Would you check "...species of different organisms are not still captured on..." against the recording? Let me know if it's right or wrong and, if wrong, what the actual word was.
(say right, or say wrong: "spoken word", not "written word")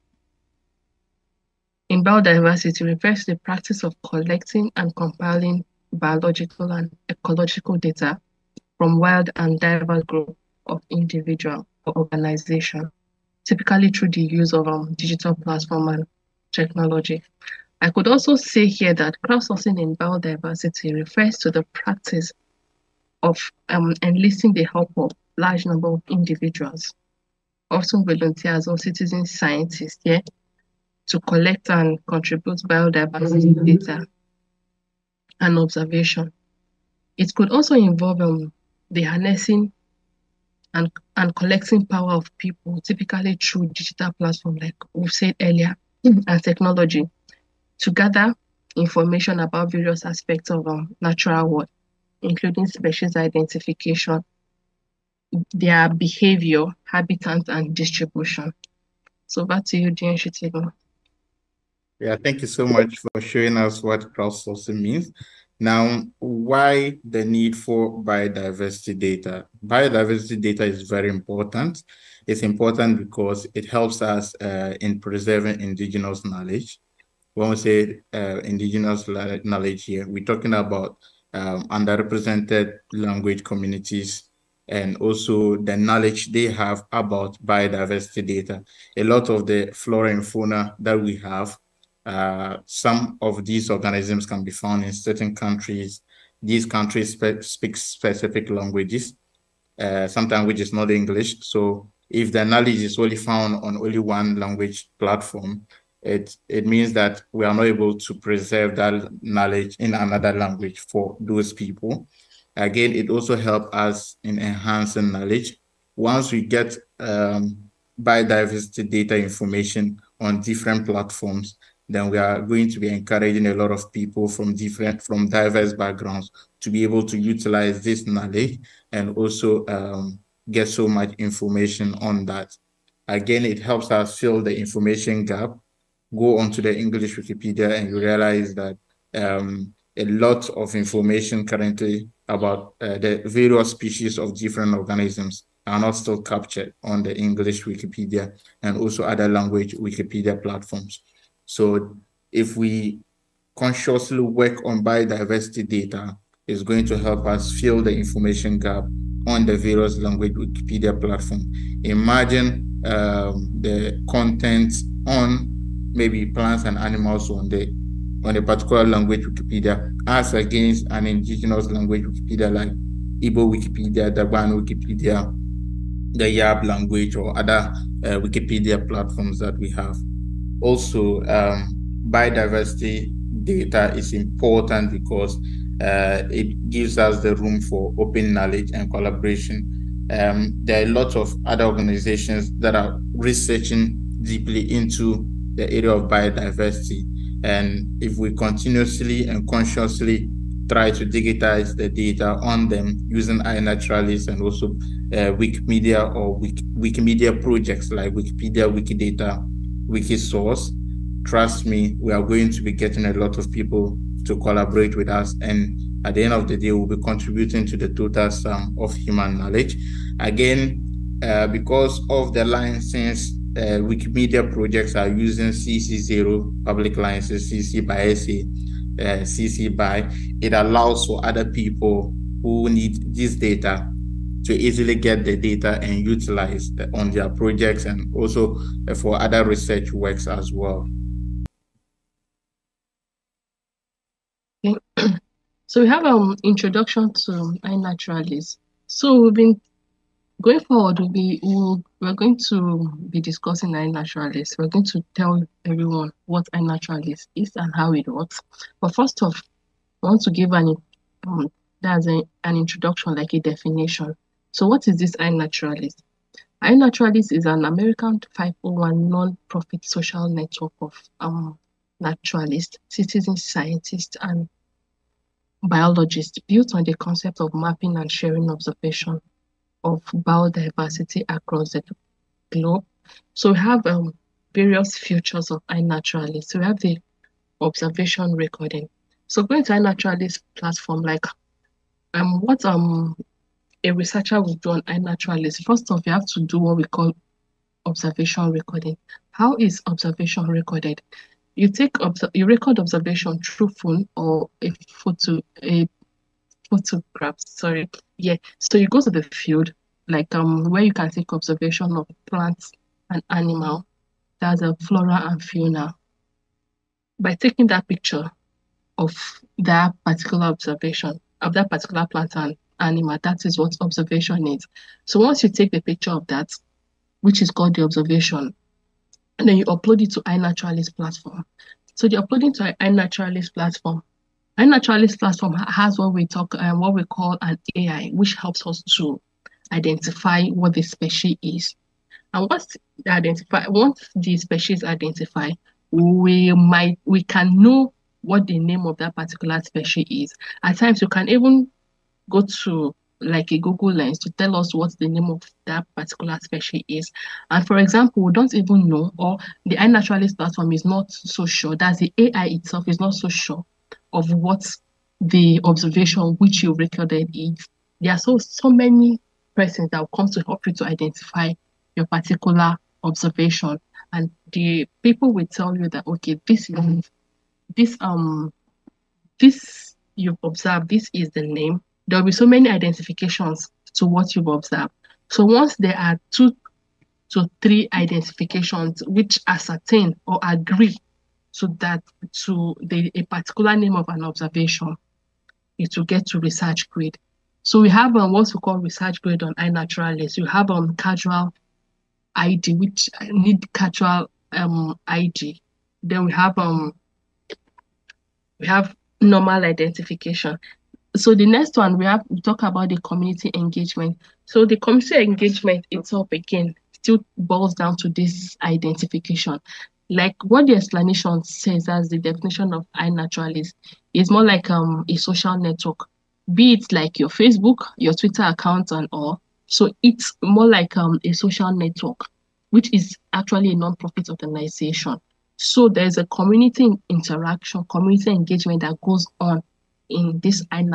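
right.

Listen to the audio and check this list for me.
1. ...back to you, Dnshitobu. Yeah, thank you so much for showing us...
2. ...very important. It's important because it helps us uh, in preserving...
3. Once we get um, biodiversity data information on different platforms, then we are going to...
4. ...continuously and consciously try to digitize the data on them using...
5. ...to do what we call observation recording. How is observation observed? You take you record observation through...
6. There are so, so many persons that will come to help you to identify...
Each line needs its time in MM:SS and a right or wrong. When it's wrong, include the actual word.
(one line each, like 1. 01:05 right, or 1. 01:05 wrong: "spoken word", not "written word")
1. 00:59 right
2. 01:10 right
3. 01:55 right
4. 03:18 right
5. 04:56 wrong: "recorded", not "observed"
6. 06:08 right.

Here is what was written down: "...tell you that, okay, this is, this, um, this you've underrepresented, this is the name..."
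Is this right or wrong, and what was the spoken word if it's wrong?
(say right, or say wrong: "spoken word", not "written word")
wrong: "observed", not "underrepresented".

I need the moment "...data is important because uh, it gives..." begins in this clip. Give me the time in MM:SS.
03:03.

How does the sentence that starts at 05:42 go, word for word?
And once identify once the species identify, we might we can know what the name of that particular species is.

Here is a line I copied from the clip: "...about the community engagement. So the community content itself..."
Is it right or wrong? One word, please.
wrong.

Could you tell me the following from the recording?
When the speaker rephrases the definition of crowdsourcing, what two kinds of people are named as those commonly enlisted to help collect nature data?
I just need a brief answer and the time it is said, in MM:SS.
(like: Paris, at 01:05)
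volunteers or citizen scientists, at 00:28.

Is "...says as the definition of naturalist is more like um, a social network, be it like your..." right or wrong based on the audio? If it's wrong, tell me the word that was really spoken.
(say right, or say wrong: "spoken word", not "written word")
wrong: "iNaturalist", not "naturalist".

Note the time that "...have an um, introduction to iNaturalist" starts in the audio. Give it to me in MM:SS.
04:05.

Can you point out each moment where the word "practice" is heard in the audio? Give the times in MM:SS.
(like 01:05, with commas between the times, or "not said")
00:03, 00:21.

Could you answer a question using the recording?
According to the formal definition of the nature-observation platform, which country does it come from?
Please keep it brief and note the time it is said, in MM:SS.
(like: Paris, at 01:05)
American, at 04:27.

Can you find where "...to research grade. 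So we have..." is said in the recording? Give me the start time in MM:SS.
06:36.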